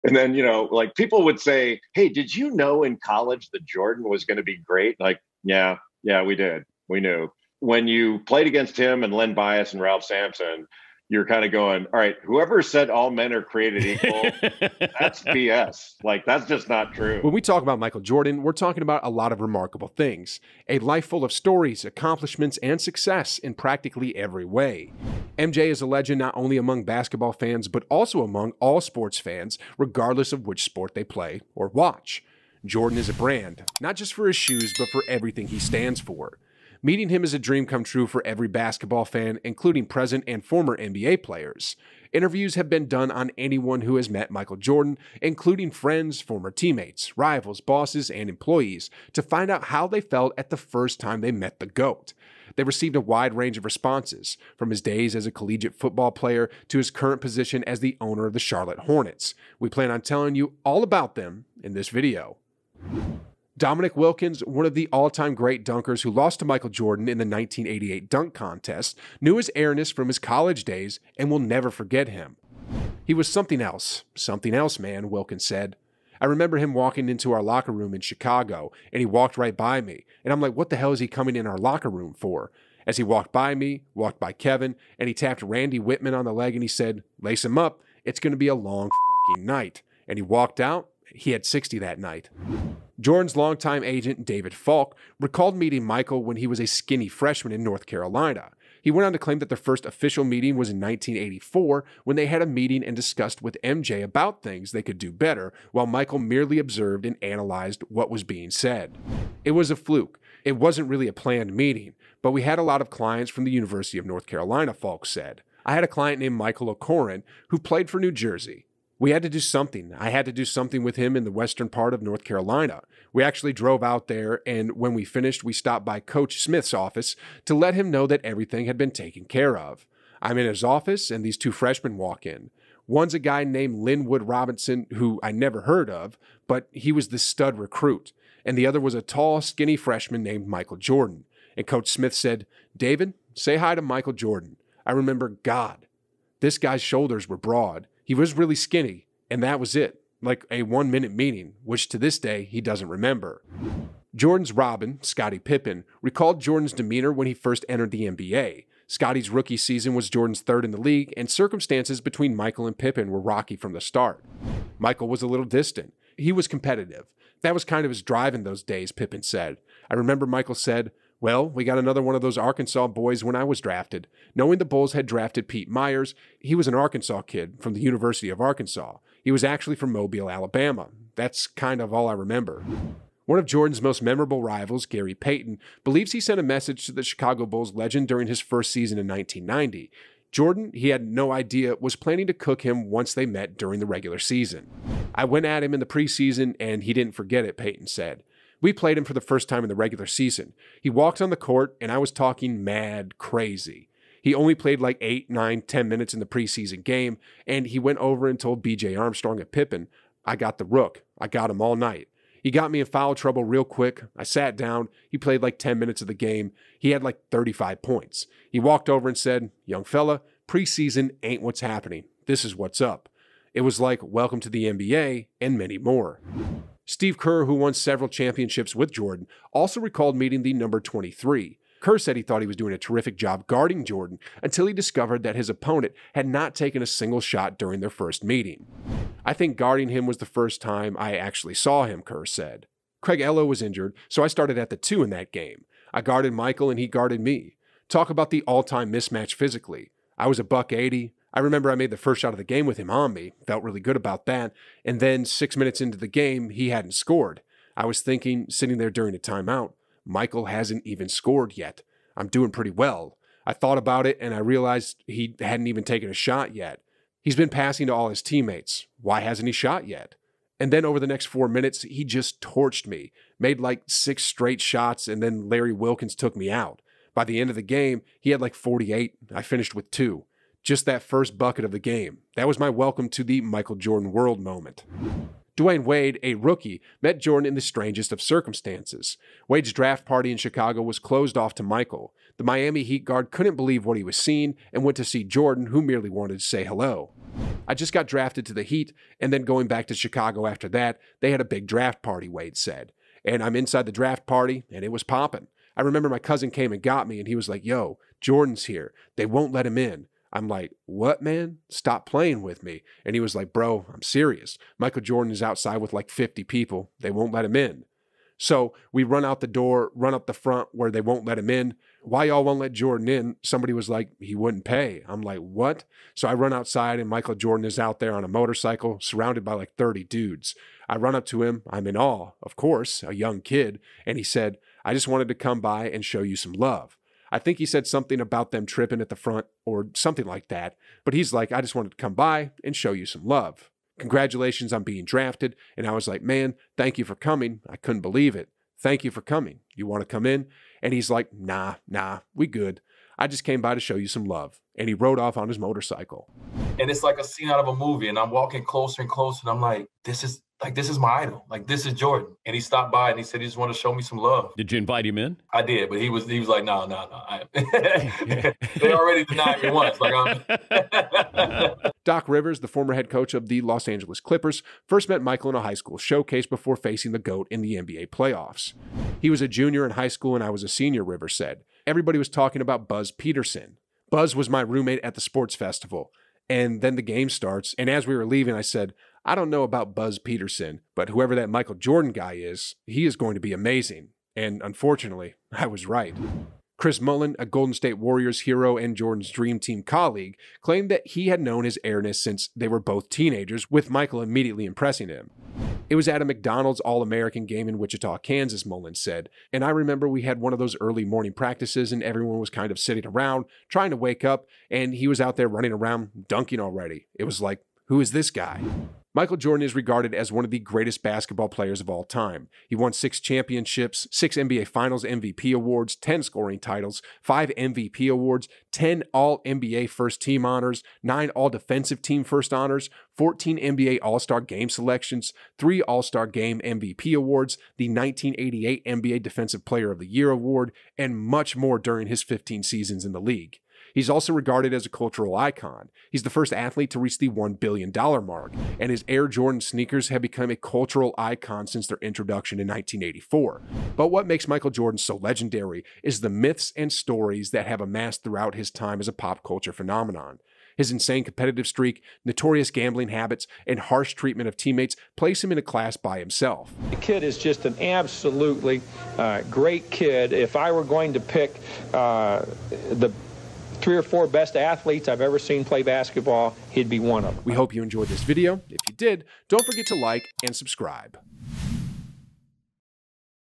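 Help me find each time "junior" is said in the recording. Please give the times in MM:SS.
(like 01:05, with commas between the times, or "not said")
06:19.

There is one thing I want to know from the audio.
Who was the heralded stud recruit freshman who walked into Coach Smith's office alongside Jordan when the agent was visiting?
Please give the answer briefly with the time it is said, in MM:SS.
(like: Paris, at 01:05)
Lynwood Robinson, at 02:13.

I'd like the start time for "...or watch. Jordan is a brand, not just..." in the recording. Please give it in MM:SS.
00:31.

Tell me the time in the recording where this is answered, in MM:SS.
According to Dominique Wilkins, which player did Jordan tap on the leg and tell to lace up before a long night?
01:25.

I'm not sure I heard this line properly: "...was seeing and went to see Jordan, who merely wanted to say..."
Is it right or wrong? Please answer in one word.
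right.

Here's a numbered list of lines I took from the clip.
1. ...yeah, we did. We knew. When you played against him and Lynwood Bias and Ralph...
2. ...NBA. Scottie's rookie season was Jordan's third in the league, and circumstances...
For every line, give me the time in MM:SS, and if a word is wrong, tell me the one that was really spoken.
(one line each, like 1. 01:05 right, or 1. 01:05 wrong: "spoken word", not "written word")
1. 00:06 wrong: "Len", not "Lynwood"
2. 02:38 right.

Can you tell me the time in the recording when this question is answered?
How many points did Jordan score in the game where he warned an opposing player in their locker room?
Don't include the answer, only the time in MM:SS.
01:31.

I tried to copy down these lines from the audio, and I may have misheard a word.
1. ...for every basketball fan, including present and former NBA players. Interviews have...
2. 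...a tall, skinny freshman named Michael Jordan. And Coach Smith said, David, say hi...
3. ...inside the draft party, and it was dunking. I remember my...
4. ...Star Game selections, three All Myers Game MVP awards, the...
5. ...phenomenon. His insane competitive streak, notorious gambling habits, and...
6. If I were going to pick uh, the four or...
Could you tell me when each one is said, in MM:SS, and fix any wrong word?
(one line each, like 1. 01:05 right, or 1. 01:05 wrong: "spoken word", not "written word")
1. 00:38 right
2. 02:18 right
3. 05:03 wrong: "popping", not "dunking"
4. 07:14 wrong: "Star", not "Myers"
5. 07:39 right
6. 07:50 wrong: "three", not "four".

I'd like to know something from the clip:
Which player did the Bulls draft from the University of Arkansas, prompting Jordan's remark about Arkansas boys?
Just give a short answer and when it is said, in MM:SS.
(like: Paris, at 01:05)
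Pete Myers, at 02:55.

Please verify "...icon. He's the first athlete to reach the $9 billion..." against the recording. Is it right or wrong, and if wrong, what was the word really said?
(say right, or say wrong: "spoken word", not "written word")
wrong: "1", not "9".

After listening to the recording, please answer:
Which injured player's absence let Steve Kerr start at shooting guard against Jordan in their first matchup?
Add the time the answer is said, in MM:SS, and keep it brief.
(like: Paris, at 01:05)
Craig Ehlo, at 04:03.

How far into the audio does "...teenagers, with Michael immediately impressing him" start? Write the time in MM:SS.
06:43.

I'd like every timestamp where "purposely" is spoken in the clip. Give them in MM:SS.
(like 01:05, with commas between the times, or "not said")
not said.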